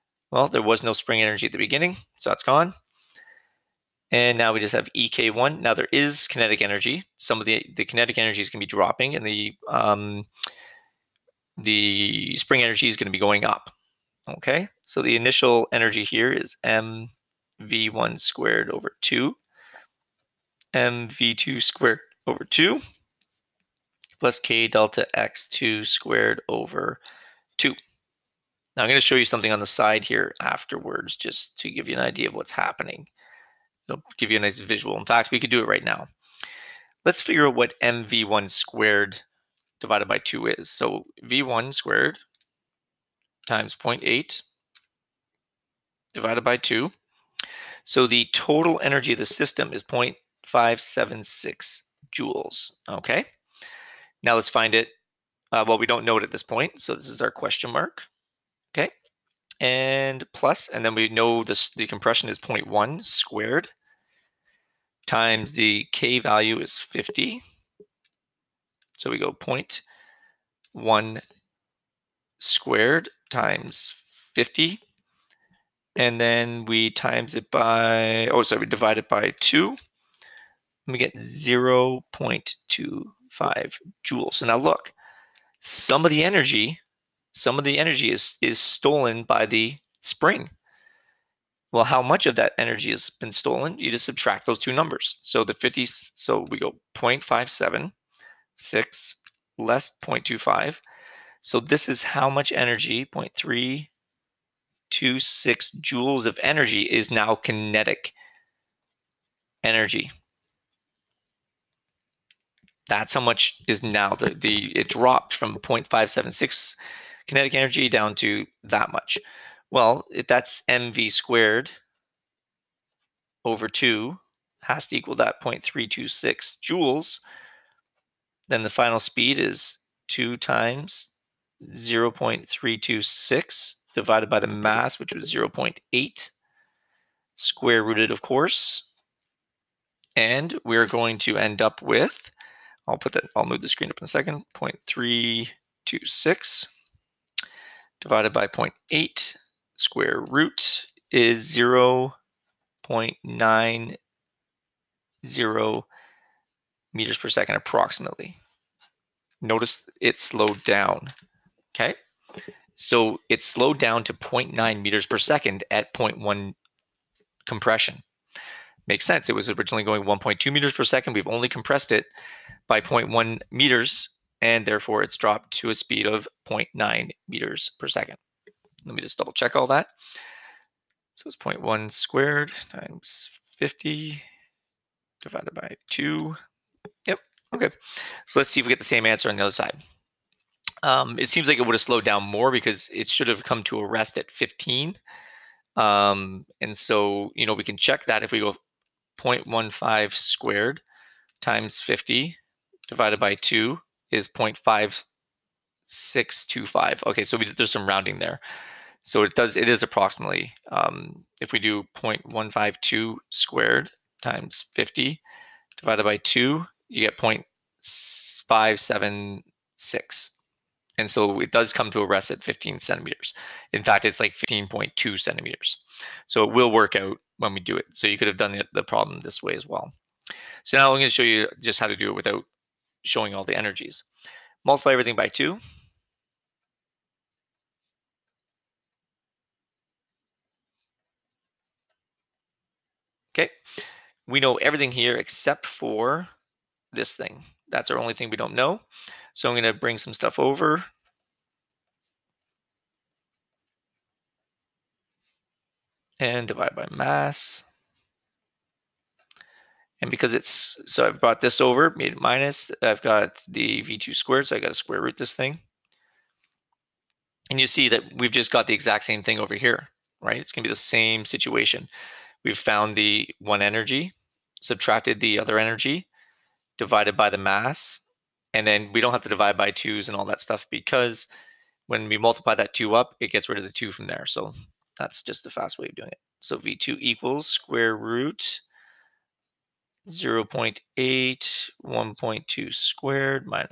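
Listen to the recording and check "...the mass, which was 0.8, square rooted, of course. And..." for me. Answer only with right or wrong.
right.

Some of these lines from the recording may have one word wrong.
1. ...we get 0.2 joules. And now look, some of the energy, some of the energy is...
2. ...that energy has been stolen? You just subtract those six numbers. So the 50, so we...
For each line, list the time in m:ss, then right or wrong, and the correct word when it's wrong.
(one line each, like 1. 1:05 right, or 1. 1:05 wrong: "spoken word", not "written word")
1. 1:20 right
2. 1:32 wrong: "two", not "six".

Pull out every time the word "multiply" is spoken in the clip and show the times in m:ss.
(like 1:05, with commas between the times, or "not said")
3:54, 4:42.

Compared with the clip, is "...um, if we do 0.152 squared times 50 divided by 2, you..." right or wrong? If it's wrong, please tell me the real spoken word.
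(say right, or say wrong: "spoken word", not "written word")
right.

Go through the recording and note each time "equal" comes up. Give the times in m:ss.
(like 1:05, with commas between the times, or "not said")
2:04, 4:47.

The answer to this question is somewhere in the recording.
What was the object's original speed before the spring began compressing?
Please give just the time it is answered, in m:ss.
2:50.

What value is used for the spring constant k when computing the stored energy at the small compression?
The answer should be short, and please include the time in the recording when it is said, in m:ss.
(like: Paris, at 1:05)
50, at 1:05.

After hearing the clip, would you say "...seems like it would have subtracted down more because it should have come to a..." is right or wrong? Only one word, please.
wrong.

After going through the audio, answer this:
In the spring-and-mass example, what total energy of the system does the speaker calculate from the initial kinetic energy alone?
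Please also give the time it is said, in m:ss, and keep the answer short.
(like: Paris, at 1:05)
0.576 joules, at 0:49.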